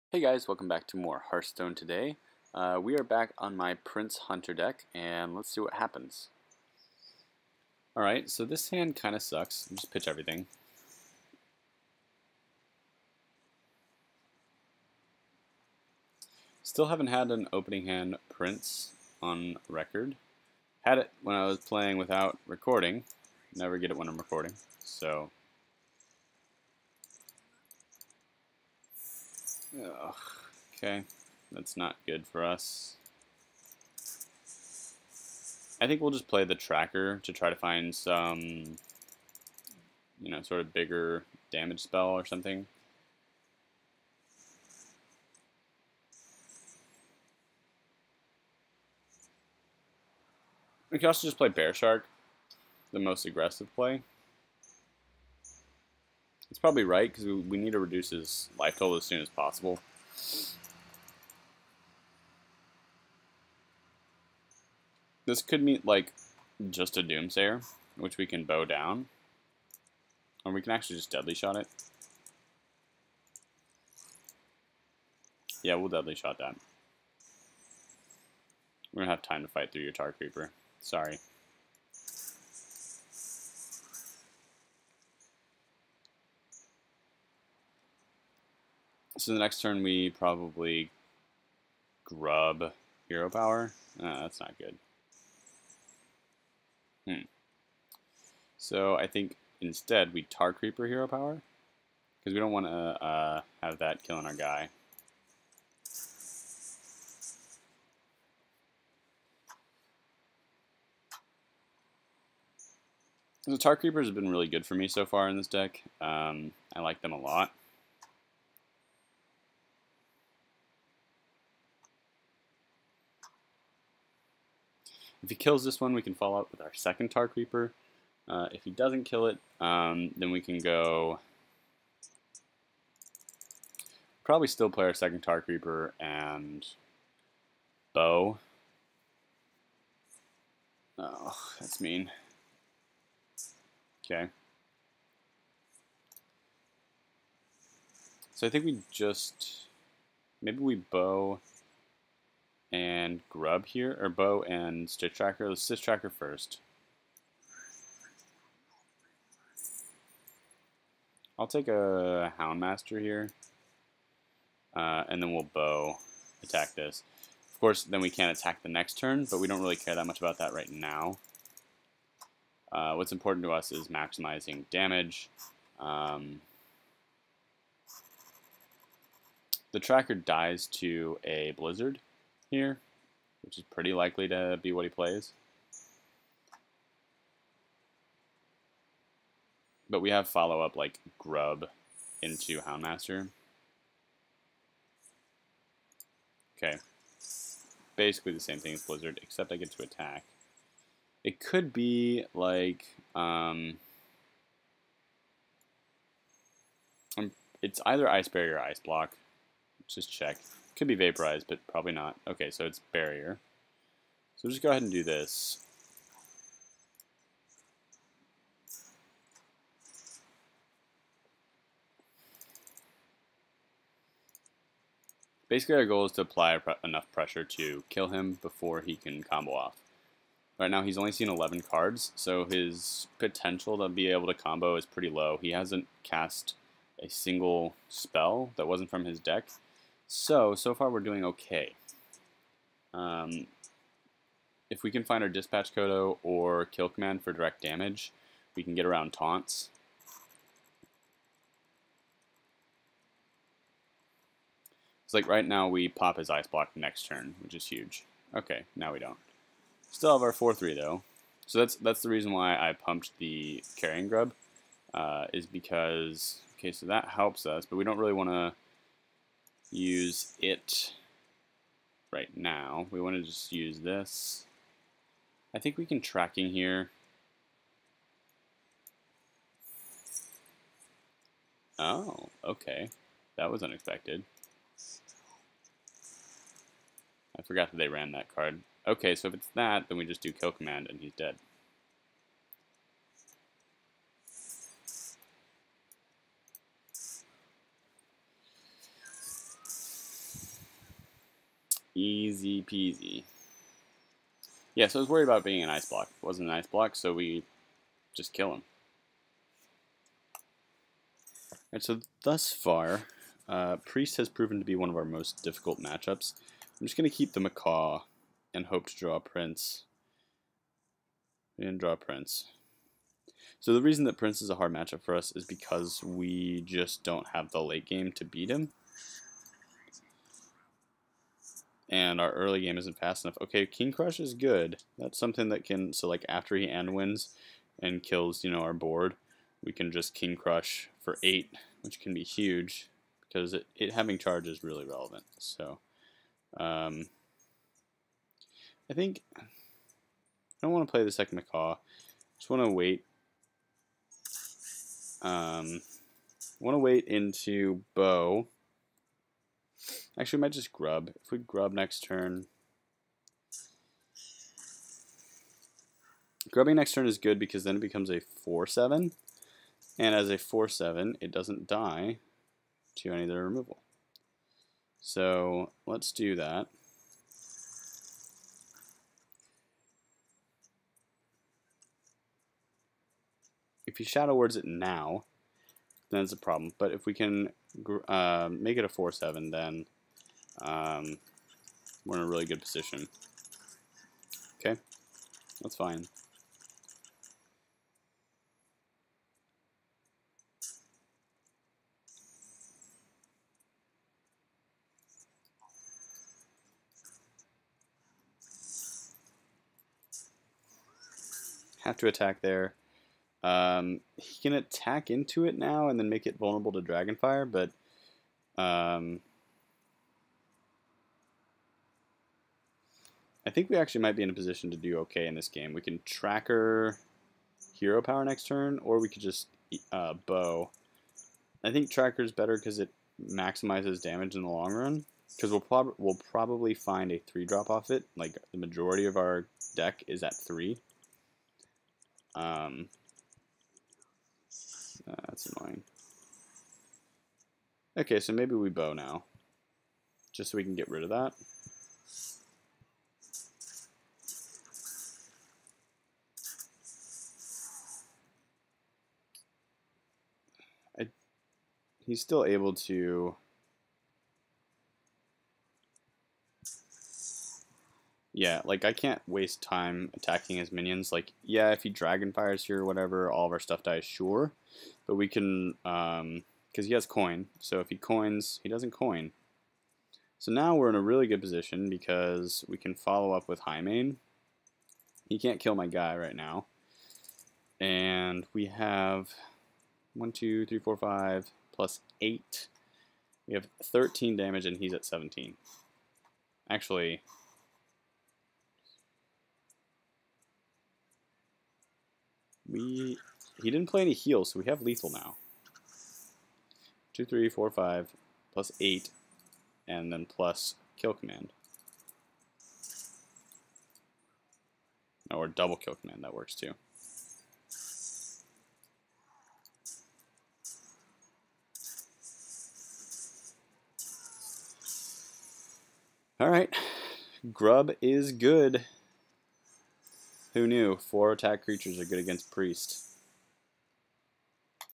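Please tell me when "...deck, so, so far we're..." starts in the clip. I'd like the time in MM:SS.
03:59.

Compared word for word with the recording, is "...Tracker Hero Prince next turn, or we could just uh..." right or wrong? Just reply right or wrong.
wrong.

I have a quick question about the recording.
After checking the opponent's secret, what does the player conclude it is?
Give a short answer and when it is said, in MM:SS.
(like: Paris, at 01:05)
Ice Barrier, at 03:32.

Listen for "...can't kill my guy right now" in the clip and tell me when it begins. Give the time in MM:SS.
08:05.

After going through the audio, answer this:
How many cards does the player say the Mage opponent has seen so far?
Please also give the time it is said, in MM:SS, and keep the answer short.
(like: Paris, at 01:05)
11, at 03:51.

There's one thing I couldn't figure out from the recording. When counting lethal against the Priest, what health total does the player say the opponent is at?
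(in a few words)
17.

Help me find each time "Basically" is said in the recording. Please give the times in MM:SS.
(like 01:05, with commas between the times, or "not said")
03:17, 03:45.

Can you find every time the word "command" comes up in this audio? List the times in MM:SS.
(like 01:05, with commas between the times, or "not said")
04:06, 04:50, 08:31, 08:35.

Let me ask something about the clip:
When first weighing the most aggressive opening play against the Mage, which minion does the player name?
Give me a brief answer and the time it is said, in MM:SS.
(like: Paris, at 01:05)
Bear Shark, at 00:51.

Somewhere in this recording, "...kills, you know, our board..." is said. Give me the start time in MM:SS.
05:38.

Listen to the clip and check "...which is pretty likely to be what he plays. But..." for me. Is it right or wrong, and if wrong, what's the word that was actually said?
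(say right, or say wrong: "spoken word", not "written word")
right.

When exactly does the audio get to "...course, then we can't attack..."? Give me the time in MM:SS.
02:47.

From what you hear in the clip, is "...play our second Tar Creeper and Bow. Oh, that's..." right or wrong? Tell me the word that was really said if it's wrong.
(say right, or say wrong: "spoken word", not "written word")
right.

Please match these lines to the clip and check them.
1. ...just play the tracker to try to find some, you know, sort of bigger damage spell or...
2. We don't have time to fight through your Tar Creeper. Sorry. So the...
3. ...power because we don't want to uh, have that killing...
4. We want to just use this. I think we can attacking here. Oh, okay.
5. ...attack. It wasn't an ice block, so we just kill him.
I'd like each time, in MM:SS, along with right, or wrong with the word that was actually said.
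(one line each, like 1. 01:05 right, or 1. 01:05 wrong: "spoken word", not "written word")
1. 00:36 right
2. 01:18 right
3. 01:41 right
4. 04:32 wrong: "tracking", not "attacking"
5. 05:05 wrong: "block", not "attack".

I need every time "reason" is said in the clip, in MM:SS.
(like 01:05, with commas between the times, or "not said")
04:22, 05:23.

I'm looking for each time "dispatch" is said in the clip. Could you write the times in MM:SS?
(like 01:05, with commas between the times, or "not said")
04:05.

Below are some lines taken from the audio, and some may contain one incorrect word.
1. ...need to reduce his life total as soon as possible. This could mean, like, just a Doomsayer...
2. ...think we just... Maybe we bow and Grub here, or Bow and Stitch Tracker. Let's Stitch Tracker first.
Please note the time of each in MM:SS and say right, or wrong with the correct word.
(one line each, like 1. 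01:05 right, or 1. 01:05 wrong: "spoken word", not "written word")
1. 00:57 right
2. 02:28 right.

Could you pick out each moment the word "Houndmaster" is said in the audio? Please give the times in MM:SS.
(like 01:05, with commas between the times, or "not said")
02:42, 03:12.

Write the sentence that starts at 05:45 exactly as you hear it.
So, um, I think I don't want to play the second macaw.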